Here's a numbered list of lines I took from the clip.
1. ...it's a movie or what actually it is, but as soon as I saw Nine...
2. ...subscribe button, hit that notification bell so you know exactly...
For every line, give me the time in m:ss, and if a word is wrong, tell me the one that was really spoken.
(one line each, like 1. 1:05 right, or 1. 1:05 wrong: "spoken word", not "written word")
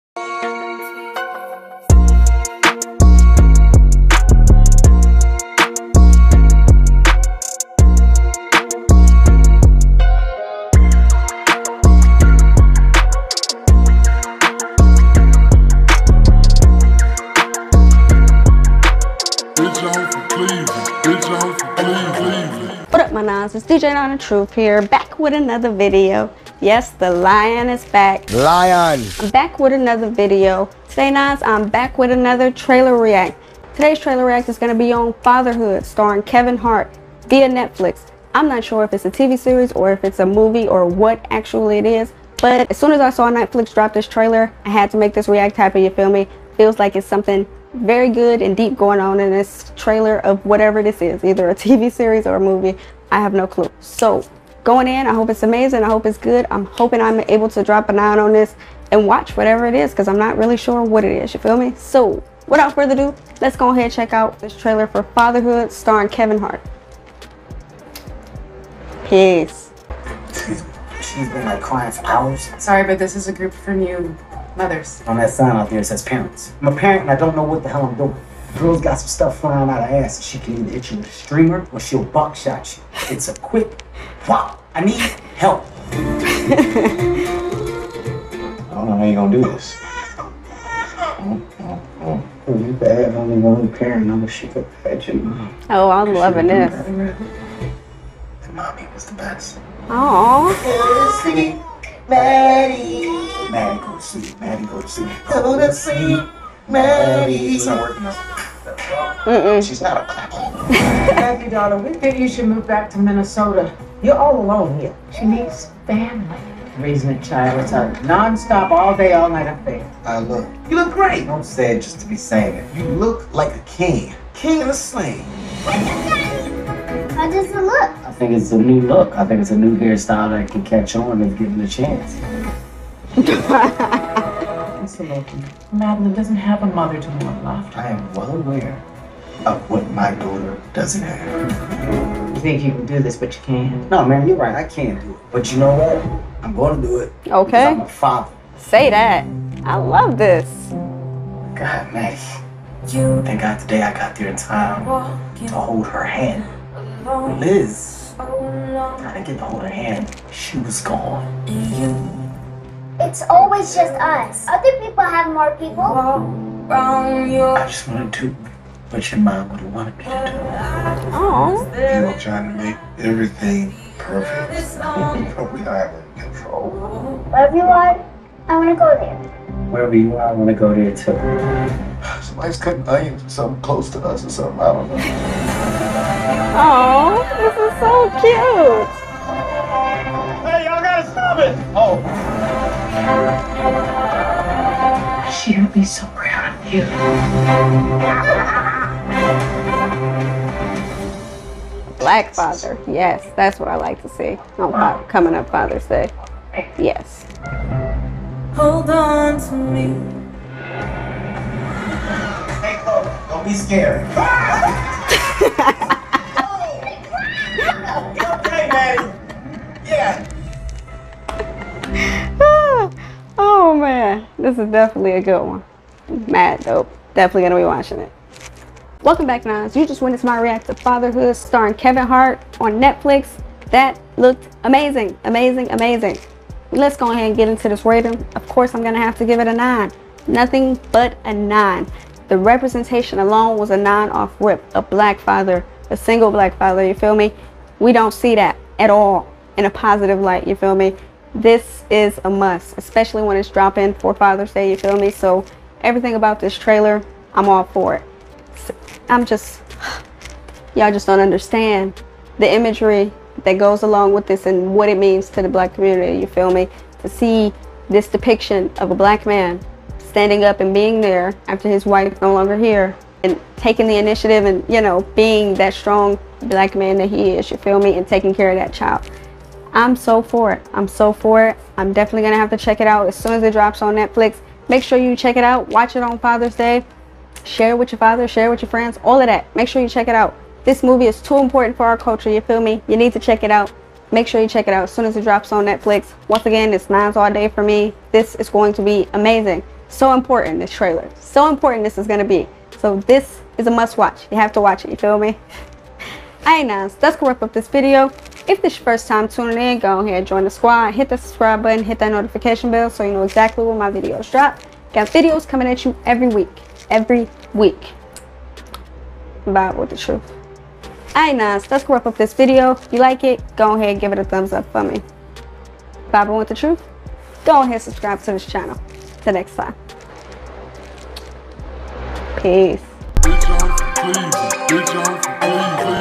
1. 0:40 wrong: "Netflix", not "Nine"
2. 5:11 right.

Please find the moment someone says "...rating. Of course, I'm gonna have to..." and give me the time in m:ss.
3:57.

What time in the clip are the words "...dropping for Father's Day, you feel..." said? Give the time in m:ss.
4:13.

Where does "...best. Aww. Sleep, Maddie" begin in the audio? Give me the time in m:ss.
1:39.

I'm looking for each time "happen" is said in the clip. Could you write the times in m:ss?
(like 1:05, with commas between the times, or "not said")
0:45.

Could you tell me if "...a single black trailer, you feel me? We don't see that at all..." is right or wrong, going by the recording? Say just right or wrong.
wrong.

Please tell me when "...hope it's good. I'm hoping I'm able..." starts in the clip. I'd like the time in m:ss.
0:55.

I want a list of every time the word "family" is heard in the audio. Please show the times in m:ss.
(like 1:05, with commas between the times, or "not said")
1:55.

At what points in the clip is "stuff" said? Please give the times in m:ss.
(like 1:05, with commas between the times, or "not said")
1:19.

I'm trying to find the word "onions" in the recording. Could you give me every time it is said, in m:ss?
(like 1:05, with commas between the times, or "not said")
3:02.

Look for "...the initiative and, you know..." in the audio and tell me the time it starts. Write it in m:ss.
4:33.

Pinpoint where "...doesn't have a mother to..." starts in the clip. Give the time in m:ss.
2:16.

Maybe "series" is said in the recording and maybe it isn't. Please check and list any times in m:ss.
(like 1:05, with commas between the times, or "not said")
0:39, 0:51.